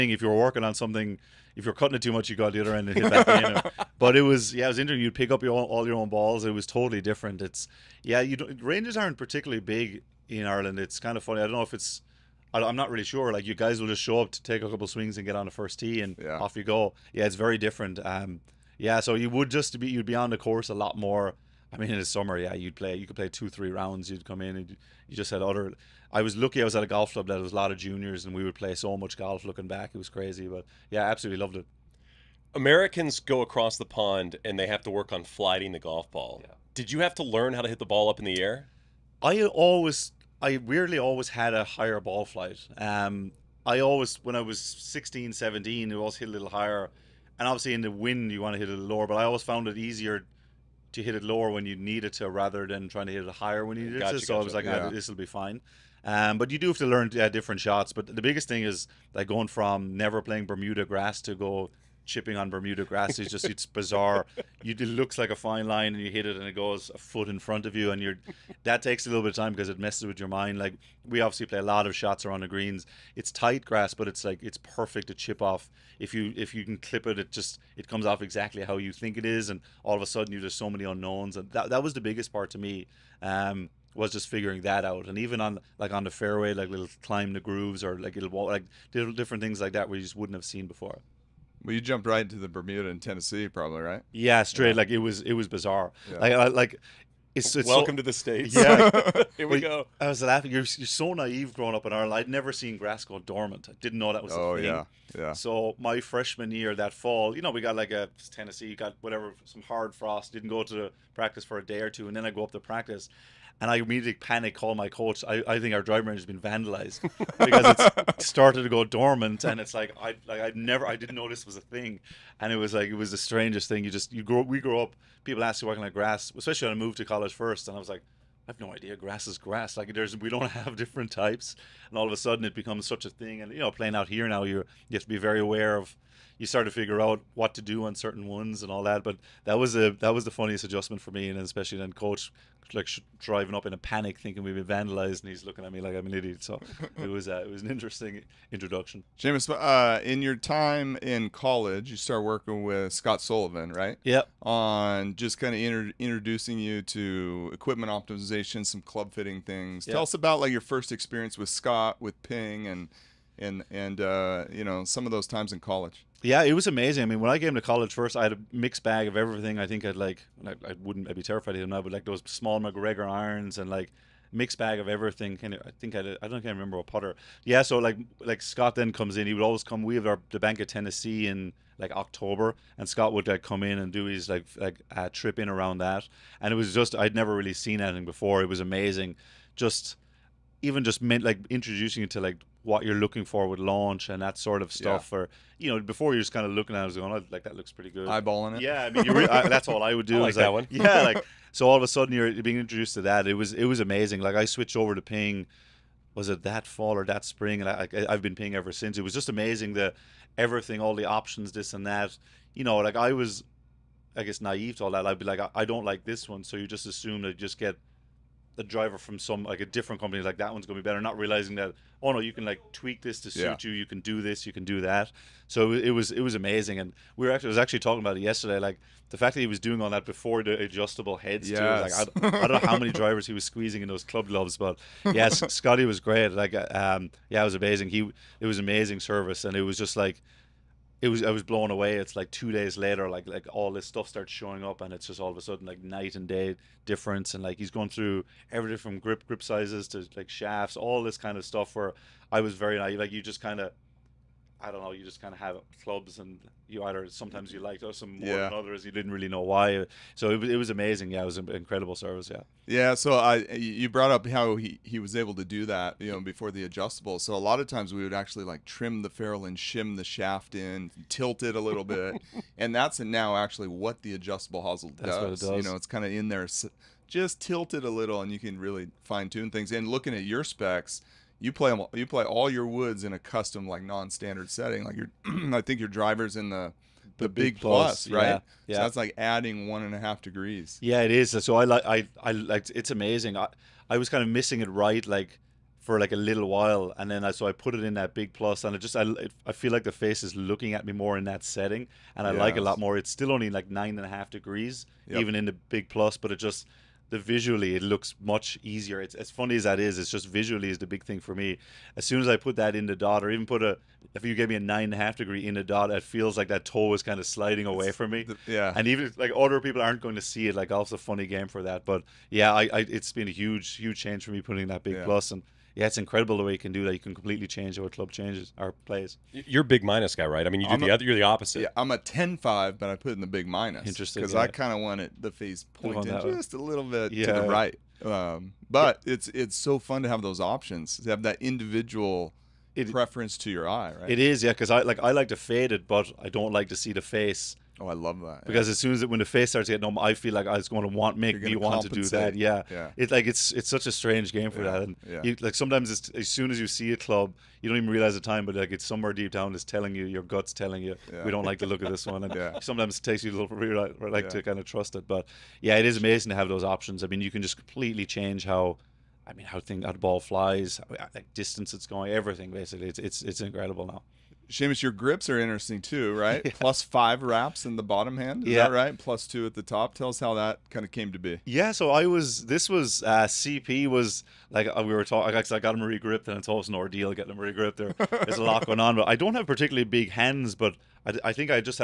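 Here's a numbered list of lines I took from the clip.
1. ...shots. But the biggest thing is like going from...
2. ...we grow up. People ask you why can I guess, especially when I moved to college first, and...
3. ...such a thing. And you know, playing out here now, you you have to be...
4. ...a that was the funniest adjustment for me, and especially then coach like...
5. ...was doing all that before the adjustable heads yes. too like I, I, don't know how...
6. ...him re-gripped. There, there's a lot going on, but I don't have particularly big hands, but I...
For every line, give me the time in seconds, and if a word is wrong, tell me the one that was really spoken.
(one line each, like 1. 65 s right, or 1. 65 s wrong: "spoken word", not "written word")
1. 57 s right
2. 124 s wrong: "grass", not "guess"
3. 132 s right
4. 139 s right
5. 229 s right
6. 387 s right.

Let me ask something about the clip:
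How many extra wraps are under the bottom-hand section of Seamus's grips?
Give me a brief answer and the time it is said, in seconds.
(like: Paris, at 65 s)
5, at 376 s.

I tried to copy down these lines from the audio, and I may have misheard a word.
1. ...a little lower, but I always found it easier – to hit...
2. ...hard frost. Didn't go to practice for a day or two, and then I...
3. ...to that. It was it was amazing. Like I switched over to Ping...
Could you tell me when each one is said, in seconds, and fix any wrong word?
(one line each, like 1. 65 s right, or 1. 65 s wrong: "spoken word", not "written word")
1. 48 s right
2. 109 s right
3. 202 s right.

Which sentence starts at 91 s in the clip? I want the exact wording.
Well, you jumped right into the Bermuda in Tennessee, probably right?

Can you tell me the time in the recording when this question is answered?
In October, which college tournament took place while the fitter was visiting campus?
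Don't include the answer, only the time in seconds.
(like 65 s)
180 s.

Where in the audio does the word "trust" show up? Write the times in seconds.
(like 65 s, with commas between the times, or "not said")
364 s.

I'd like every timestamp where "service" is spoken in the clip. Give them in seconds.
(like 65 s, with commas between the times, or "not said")
238 s, 261 s.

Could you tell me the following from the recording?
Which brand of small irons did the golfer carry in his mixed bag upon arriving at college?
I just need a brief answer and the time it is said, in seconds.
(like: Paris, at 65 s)
MacGregor, at 172 s.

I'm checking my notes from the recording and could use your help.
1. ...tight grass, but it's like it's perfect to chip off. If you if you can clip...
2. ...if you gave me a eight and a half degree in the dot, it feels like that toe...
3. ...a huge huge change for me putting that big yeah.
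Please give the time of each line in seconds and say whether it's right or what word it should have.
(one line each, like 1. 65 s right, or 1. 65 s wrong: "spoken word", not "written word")
1. 73 s right
2. 314 s wrong: "nine", not "eight"
3. 323 s right.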